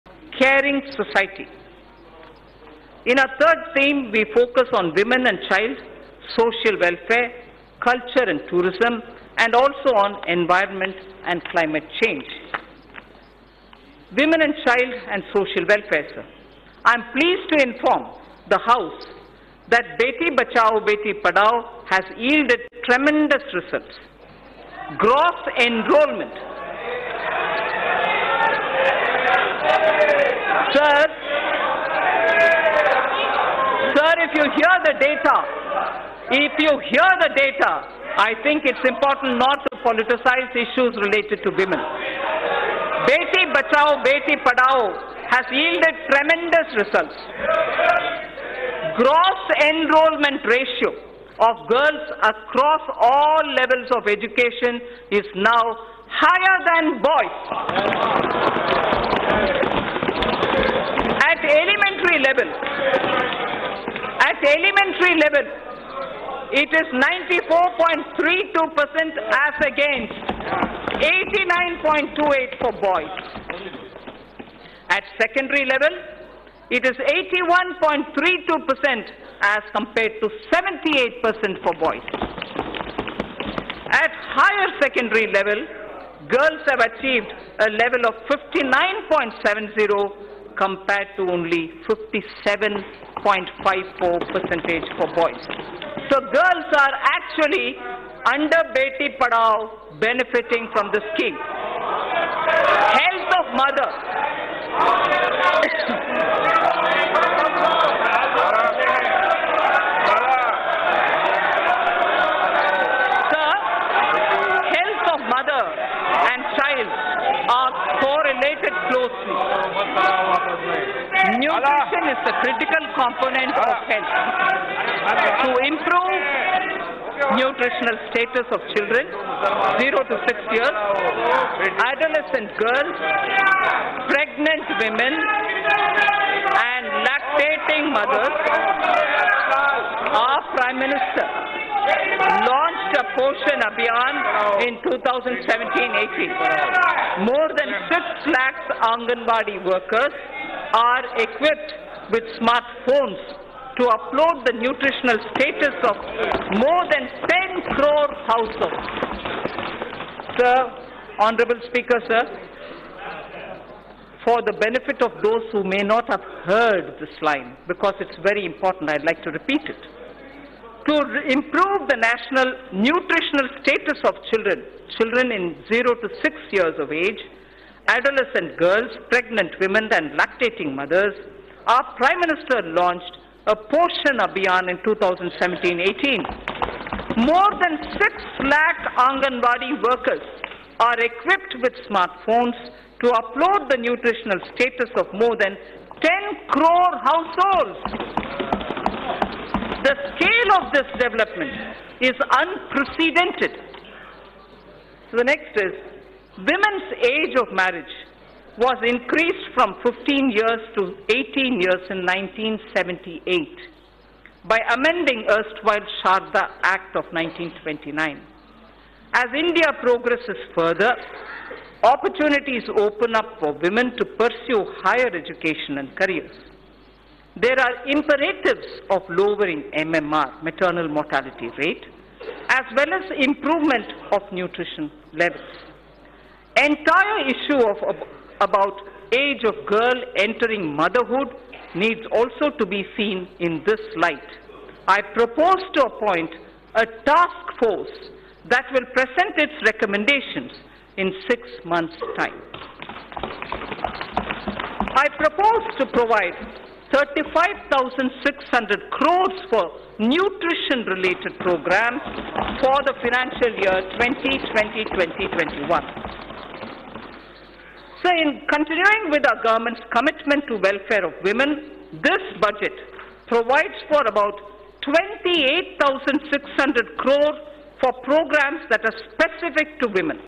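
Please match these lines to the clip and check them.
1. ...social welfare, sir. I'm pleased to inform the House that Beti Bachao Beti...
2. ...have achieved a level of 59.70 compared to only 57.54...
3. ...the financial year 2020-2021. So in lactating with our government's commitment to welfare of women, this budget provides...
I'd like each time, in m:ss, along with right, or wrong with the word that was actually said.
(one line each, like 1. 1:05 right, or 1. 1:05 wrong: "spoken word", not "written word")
1. 0:15 right
2. 1:26 right
3. 4:22 wrong: "continuing", not "lactating".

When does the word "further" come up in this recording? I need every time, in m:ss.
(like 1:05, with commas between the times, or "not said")
3:40.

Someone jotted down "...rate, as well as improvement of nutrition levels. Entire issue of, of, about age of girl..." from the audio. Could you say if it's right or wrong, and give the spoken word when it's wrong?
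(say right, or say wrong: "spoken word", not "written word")
right.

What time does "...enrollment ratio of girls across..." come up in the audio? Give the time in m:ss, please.
0:49.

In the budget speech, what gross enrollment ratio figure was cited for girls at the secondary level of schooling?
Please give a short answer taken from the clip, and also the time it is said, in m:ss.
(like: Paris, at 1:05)
81.32%, at 1:17.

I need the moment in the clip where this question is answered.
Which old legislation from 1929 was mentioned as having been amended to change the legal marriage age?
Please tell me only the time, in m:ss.
3:36.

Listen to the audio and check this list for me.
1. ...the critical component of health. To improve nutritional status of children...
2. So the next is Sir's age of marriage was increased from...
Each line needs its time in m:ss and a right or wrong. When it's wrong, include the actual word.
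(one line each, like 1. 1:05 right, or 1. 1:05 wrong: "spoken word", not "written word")
1. 2:02 right
2. 3:25 wrong: "Women", not "Sir".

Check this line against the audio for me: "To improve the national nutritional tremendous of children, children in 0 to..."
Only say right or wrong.
wrong.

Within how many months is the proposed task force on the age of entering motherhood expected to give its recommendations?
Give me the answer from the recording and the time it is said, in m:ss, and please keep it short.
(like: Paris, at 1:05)
6 months, at 4:11.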